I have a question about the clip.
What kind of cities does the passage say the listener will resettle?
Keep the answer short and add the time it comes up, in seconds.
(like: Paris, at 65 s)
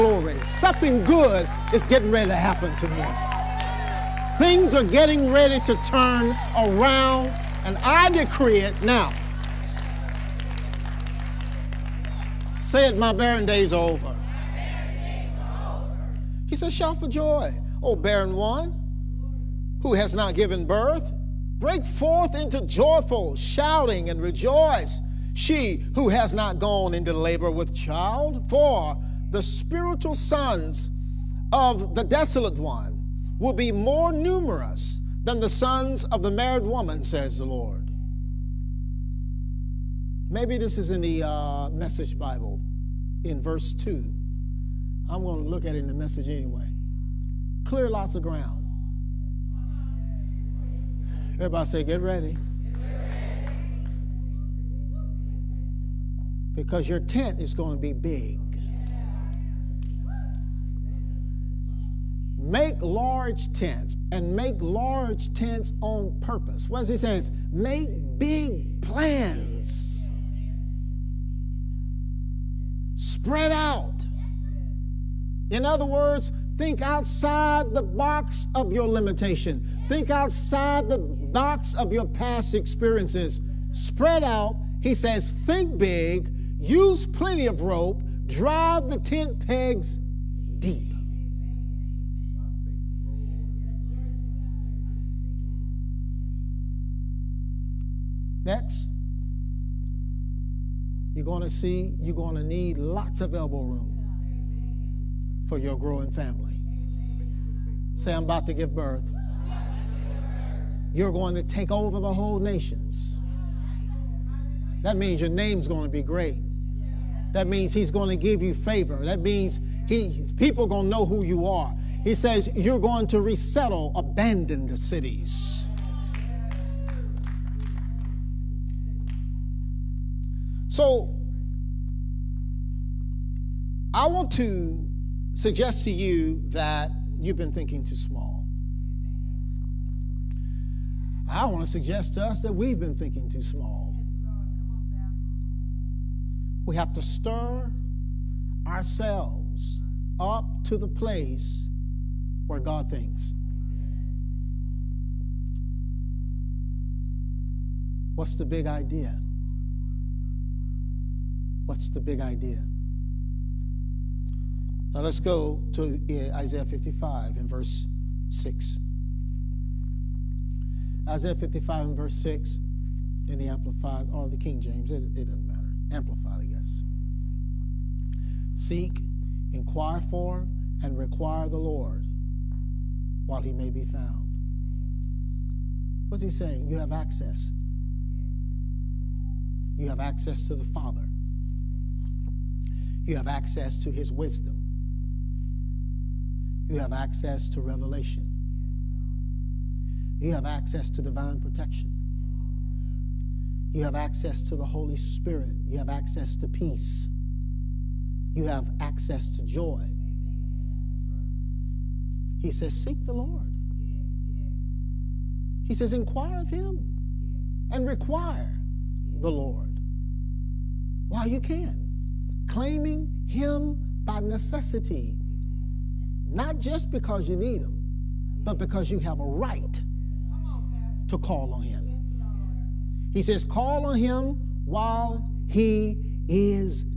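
abandoned cities, at 123 s.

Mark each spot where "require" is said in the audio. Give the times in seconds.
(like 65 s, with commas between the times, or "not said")
180 s, 217 s.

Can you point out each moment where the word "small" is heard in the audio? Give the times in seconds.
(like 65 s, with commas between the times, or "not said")
137 s, 143 s.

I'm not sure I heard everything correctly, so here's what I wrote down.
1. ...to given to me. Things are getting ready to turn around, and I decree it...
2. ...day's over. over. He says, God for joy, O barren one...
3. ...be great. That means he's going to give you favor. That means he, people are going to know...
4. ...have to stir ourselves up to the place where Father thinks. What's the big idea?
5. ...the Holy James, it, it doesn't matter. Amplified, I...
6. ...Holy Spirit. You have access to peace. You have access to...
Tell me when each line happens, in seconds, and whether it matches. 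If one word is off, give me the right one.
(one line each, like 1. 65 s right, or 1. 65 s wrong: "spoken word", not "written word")
1. 2 s wrong: "happen", not "given"
2. 13 s wrong: "Shout", not "God"
3. 115 s right
4. 146 s wrong: "God", not "Father"
5. 174 s wrong: "King", not "Holy"
6. 204 s right.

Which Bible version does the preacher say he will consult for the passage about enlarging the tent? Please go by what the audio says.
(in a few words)
Message Bible.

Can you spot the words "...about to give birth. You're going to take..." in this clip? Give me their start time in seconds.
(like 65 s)
108 s.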